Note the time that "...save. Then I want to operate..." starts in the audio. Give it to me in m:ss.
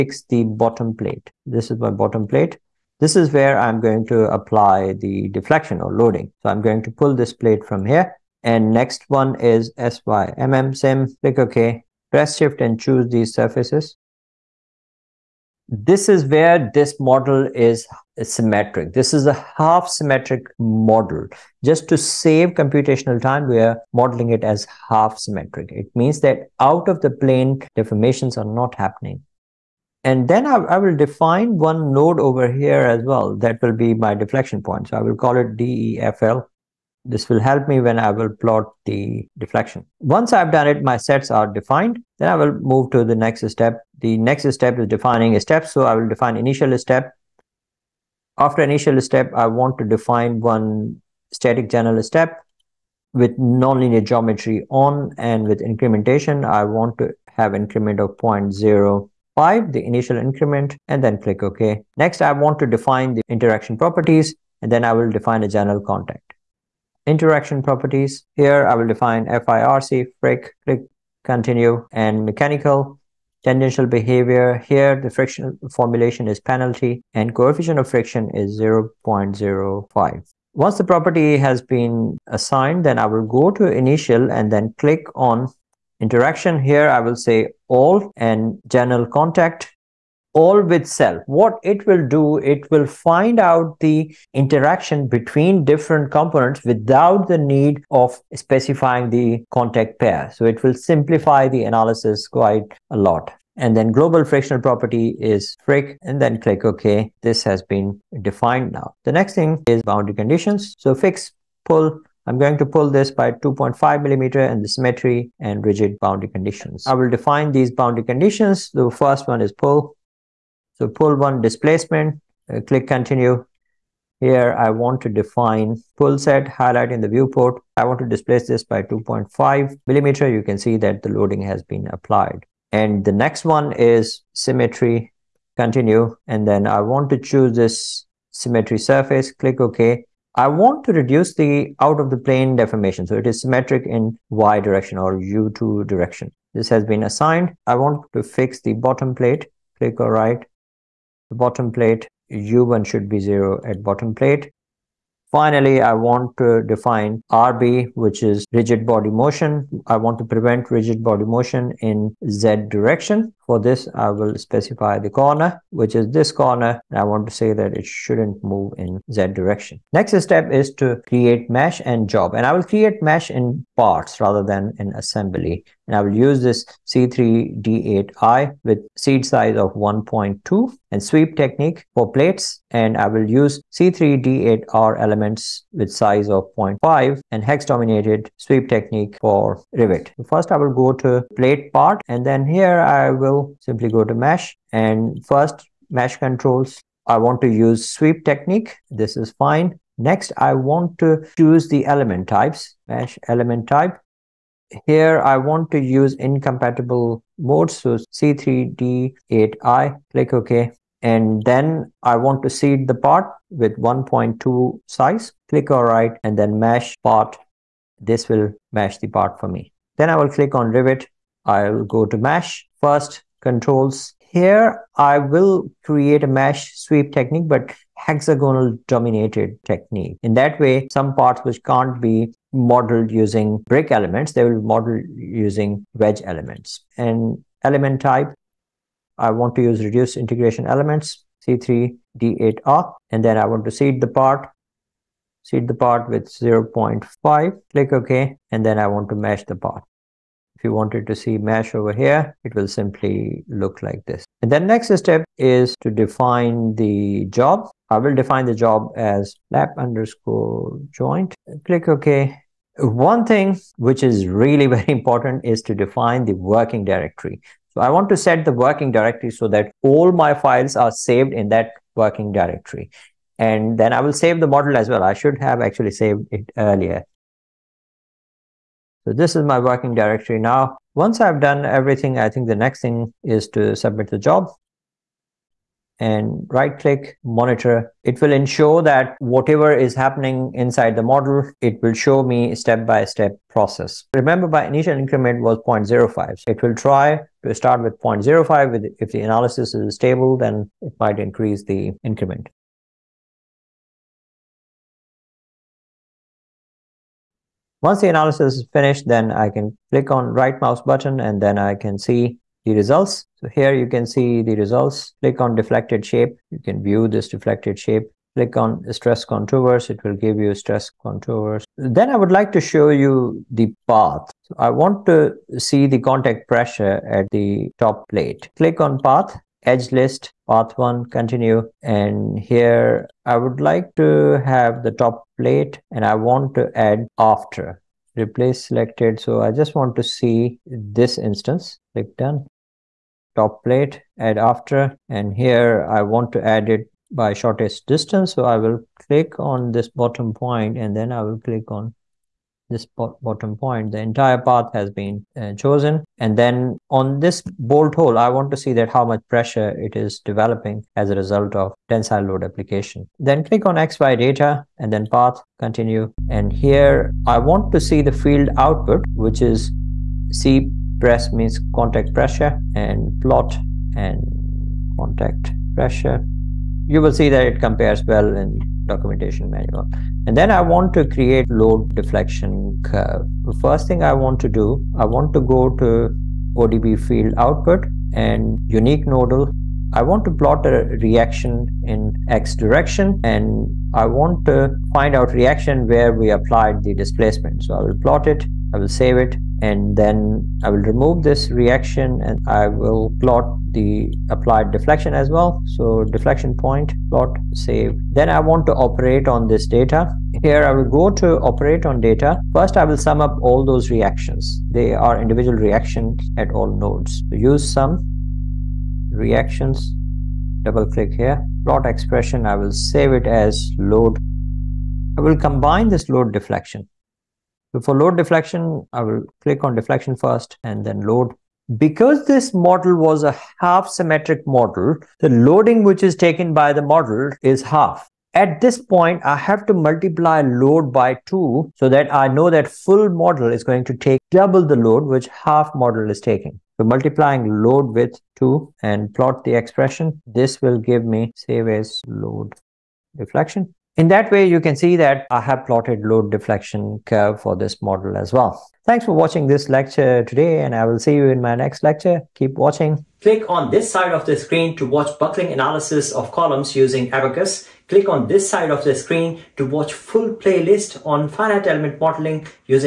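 6:47.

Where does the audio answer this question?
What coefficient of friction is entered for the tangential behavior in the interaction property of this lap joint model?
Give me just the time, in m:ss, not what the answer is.
1:17.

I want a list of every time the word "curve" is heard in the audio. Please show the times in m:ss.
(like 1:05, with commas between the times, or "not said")
6:22, 7:37.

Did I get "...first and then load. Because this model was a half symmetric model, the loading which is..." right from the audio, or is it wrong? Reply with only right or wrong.
right.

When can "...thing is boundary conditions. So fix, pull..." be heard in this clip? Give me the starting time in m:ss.
1:49.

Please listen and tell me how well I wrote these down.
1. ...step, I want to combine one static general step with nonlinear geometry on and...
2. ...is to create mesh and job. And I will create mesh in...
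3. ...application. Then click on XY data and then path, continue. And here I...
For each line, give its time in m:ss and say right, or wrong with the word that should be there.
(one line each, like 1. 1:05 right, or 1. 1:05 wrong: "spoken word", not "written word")
1. 0:48 wrong: "define", not "combine"
2. 2:50 right
3. 6:02 right.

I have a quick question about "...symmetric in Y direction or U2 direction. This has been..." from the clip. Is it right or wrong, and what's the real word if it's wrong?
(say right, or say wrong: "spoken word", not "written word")
right.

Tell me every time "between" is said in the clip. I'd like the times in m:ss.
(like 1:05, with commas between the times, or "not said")
1:35.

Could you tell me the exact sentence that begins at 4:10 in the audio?
If you wanted to see mesh over here, it will simply look like this.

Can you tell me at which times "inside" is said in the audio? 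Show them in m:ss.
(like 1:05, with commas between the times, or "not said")
4:50.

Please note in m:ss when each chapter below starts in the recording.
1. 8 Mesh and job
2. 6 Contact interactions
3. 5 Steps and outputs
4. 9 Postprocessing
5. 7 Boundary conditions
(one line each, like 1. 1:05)
1. 2:49
2. 1:02
3. 0:43
4. 5:05
5. 1:48.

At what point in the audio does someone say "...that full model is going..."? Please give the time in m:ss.
7:22.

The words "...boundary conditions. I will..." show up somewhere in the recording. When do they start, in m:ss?
1:55.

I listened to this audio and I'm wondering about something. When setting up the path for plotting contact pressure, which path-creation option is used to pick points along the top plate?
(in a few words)
shortest distance.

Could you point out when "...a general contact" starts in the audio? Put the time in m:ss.
1:05.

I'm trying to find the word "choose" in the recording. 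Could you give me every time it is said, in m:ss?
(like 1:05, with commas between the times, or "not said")
0:12, 2:17, 3:21.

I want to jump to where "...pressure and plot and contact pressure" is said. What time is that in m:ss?
6:12.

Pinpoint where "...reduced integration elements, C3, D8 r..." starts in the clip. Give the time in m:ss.
3:59.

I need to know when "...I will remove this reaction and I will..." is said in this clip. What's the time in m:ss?
6:40.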